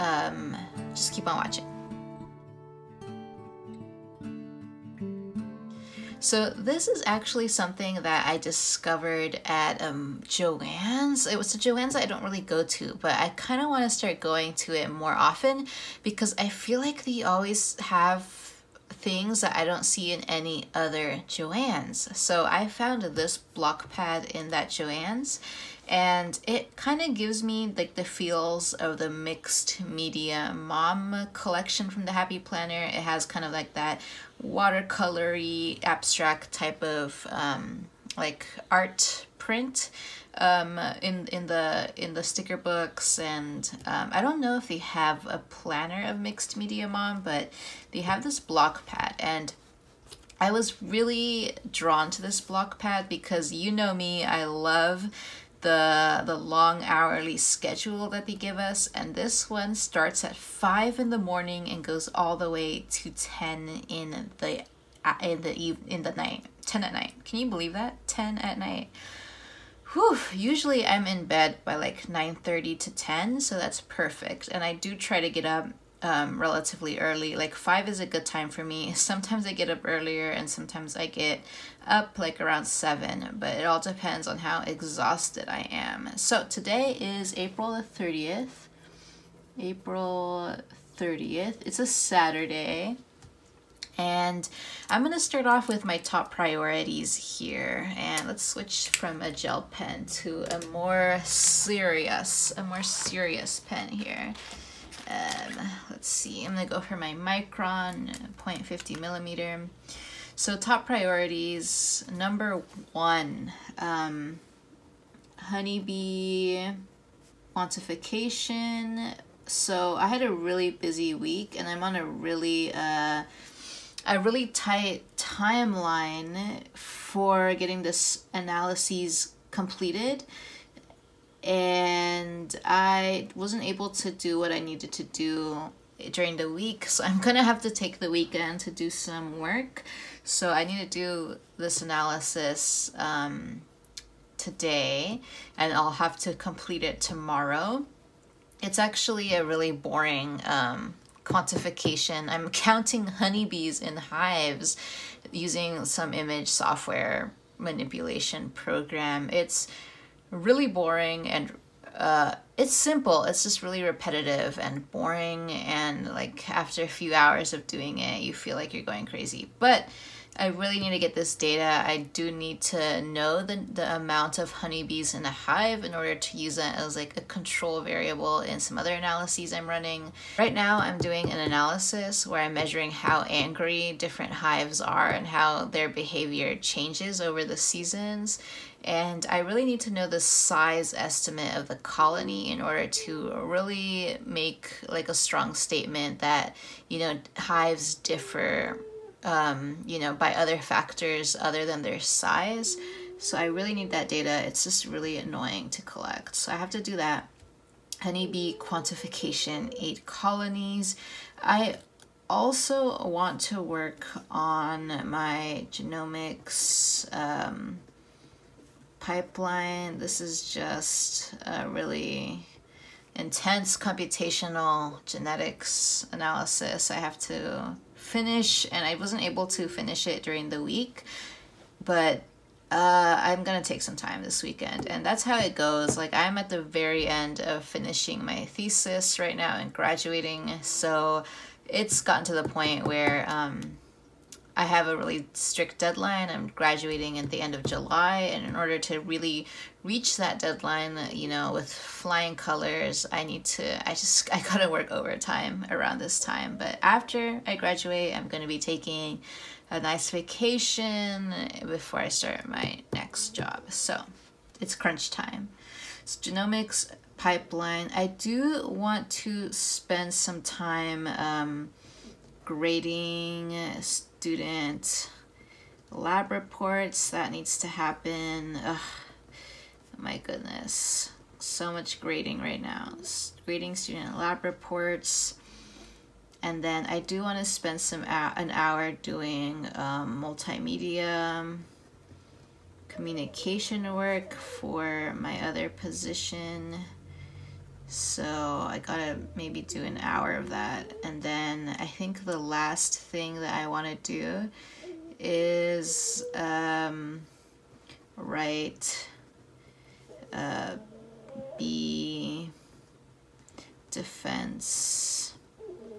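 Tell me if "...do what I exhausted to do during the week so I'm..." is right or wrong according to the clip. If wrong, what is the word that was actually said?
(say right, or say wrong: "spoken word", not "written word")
wrong: "needed", not "exhausted".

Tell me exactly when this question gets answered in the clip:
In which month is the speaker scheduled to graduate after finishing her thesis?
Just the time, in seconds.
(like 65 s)
247 s.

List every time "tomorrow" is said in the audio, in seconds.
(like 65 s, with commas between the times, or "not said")
147 s.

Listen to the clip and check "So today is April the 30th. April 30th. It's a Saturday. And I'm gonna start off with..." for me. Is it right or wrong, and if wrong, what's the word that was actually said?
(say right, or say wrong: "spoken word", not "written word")
right.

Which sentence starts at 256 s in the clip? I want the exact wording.
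But after I graduate, I'm gonna be taking a nice vacation before I start my next job.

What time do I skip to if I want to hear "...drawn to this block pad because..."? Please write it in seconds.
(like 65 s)
51 s.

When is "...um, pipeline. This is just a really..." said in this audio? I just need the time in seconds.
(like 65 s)
217 s.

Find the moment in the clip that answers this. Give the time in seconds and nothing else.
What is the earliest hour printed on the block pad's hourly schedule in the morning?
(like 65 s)
60 s.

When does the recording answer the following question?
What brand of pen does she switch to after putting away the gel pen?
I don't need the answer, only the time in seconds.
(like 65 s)
107 s.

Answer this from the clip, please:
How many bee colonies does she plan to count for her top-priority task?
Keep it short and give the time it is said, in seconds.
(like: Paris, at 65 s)
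8, at 209 s.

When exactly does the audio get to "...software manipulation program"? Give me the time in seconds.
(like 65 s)
156 s.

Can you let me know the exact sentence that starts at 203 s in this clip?
So I really need that data.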